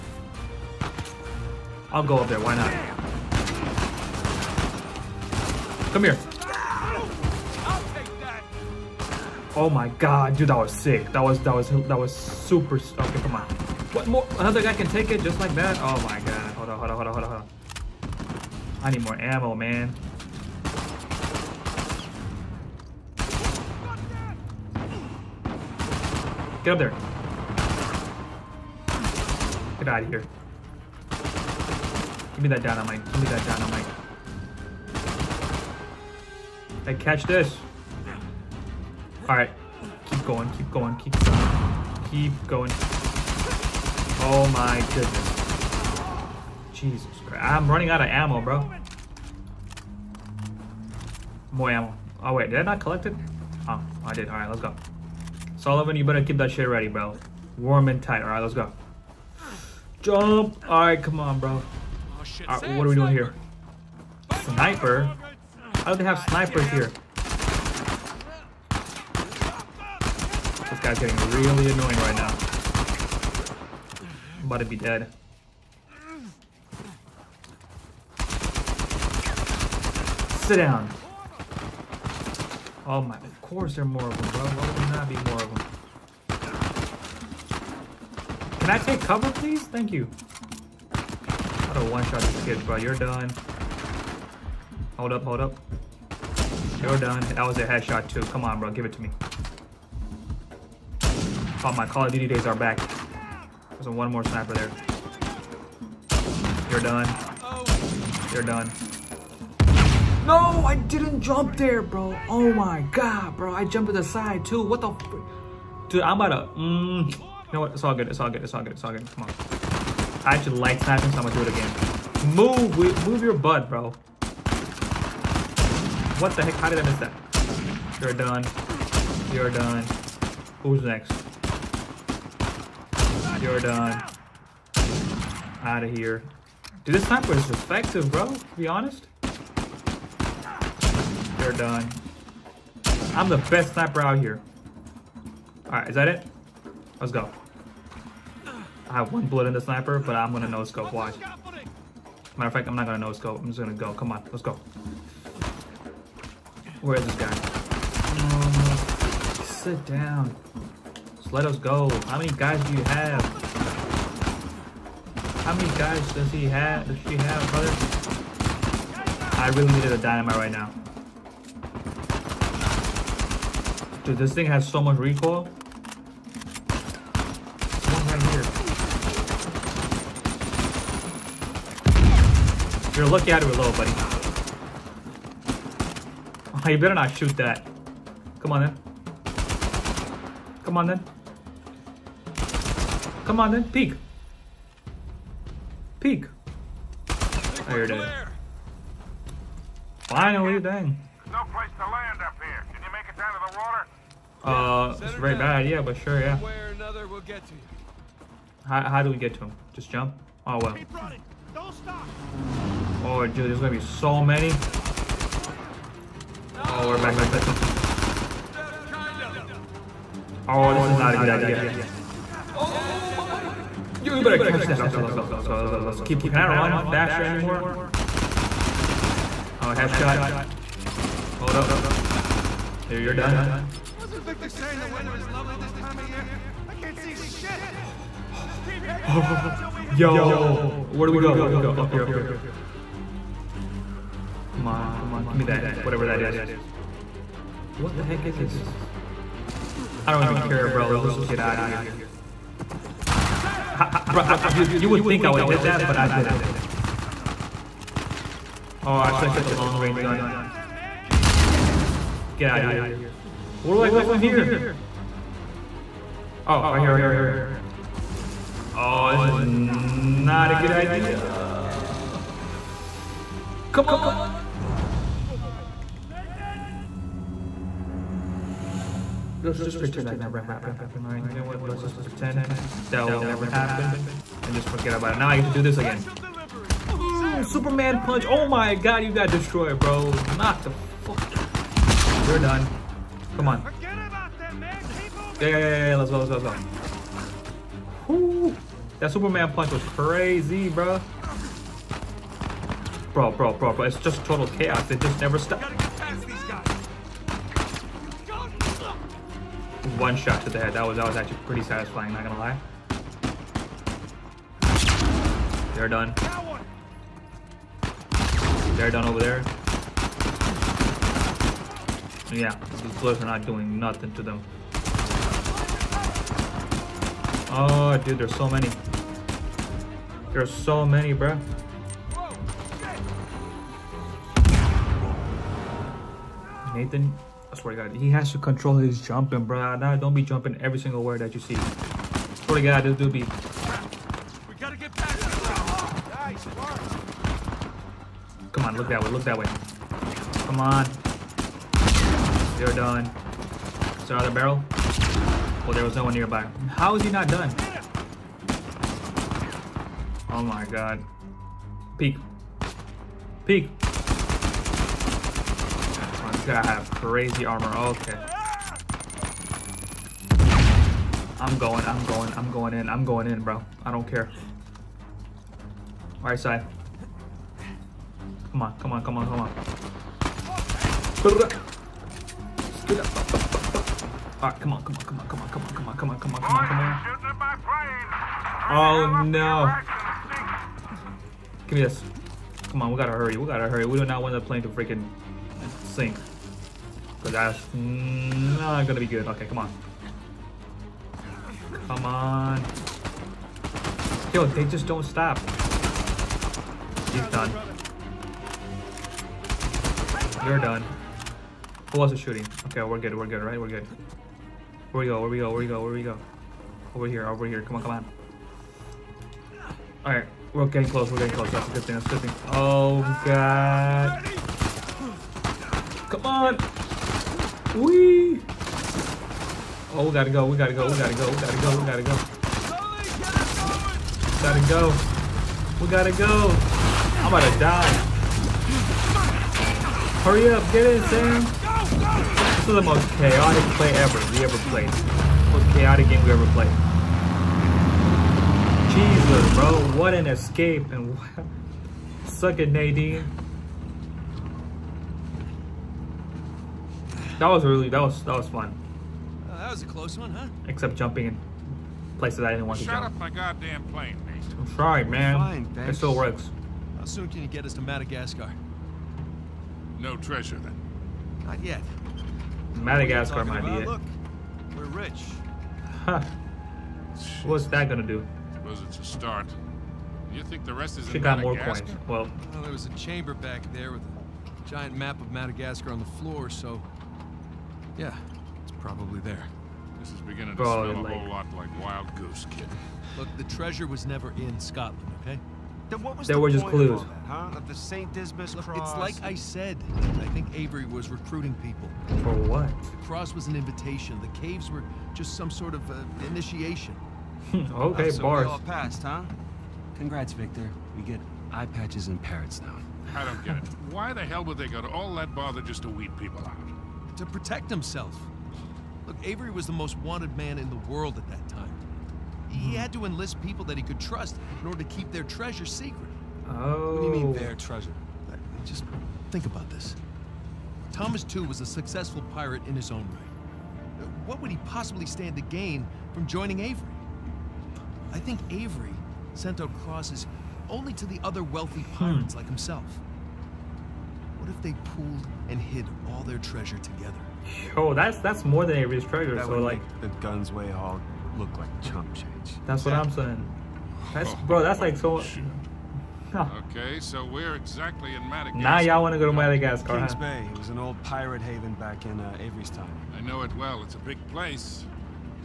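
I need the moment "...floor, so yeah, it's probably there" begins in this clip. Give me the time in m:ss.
8:06.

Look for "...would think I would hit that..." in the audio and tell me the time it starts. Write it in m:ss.
4:14.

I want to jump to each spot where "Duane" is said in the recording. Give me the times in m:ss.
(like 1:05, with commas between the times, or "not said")
not said.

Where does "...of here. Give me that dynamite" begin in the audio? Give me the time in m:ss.
0:30.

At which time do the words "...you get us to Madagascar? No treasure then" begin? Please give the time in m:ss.
7:47.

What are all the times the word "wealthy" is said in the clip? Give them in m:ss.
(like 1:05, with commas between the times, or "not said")
9:01.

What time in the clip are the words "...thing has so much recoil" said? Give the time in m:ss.
2:54.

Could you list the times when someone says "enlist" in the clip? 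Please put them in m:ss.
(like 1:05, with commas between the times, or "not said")
8:43.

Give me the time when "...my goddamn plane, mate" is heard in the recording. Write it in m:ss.
7:43.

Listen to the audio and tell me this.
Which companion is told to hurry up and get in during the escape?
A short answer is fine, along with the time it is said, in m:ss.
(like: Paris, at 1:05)
Sam, at 7:21.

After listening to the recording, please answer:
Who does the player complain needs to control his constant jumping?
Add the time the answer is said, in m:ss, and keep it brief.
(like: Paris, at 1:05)
Nathan, at 5:36.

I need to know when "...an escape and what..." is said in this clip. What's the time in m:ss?
7:30.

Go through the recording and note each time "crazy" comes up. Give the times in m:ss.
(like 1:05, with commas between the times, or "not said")
4:59, 6:06.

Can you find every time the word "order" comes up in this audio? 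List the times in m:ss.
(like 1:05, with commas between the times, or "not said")
8:44.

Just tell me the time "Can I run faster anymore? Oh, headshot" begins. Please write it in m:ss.
3:46.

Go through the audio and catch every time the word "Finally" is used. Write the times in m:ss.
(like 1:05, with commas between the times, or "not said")
3:19.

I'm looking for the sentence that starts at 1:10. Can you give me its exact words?
guy's getting really annoying right now.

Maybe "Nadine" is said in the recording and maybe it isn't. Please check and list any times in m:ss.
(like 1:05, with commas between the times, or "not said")
7:32.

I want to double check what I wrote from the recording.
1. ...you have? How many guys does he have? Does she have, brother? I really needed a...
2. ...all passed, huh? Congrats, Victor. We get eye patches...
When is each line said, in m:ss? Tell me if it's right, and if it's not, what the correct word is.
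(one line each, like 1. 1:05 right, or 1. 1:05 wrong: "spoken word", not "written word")
1. 2:42 right
2. 8:28 right.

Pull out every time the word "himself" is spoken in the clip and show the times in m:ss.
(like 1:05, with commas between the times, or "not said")
8:37, 9:02.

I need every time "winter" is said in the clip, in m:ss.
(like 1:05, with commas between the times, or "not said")
not said.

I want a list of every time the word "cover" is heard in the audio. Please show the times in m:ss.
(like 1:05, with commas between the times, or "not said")
1:28.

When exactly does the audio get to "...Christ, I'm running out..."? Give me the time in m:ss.
0:47.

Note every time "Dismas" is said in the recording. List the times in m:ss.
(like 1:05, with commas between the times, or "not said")
8:18.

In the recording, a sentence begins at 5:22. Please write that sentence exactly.
Yeah, these bullets are not doing nothing to them.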